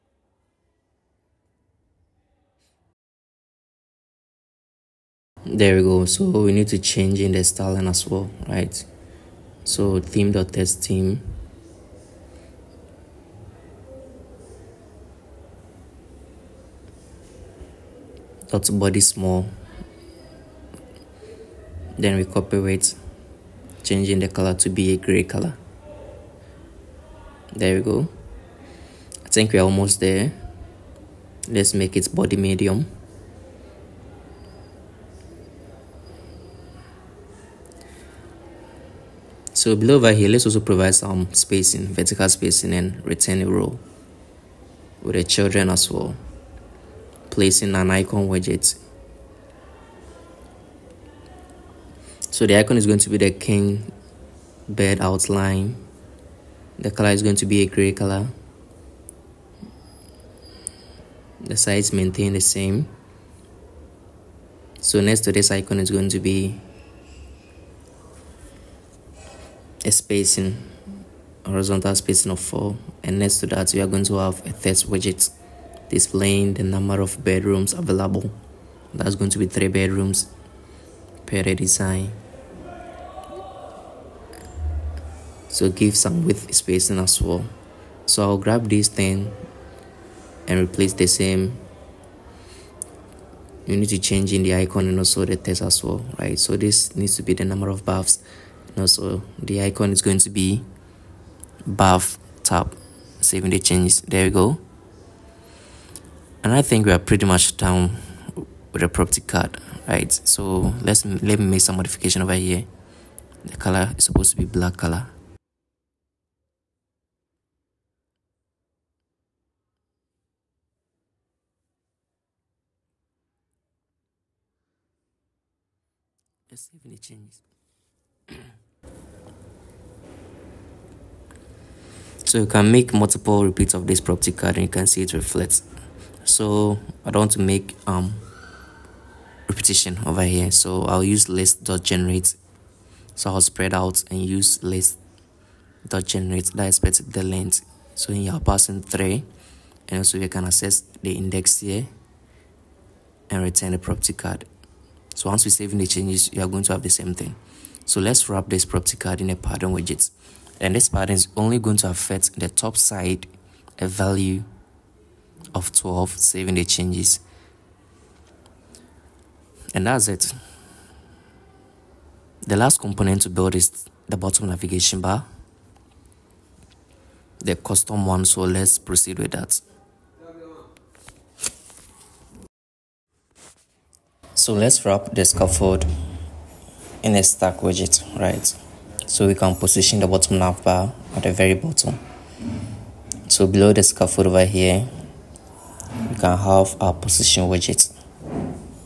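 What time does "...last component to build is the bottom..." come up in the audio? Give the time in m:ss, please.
2:52.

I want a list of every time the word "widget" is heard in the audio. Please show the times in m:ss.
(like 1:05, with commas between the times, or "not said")
0:48, 1:14, 2:39, 3:07, 3:17.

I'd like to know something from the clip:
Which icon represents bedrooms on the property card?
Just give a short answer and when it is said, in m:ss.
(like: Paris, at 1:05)
king bed outline, at 0:53.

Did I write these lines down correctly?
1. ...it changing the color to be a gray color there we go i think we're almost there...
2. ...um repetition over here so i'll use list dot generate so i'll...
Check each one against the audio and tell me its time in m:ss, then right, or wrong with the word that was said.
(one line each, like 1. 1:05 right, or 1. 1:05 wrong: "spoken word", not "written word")
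1. 0:22 right
2. 2:17 right.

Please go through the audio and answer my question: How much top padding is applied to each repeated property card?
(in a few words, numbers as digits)
12.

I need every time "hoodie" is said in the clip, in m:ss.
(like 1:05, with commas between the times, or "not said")
not said.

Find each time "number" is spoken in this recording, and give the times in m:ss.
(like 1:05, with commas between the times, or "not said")
1:16, 1:37.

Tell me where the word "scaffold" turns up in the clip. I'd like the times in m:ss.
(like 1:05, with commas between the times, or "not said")
3:05, 3:13.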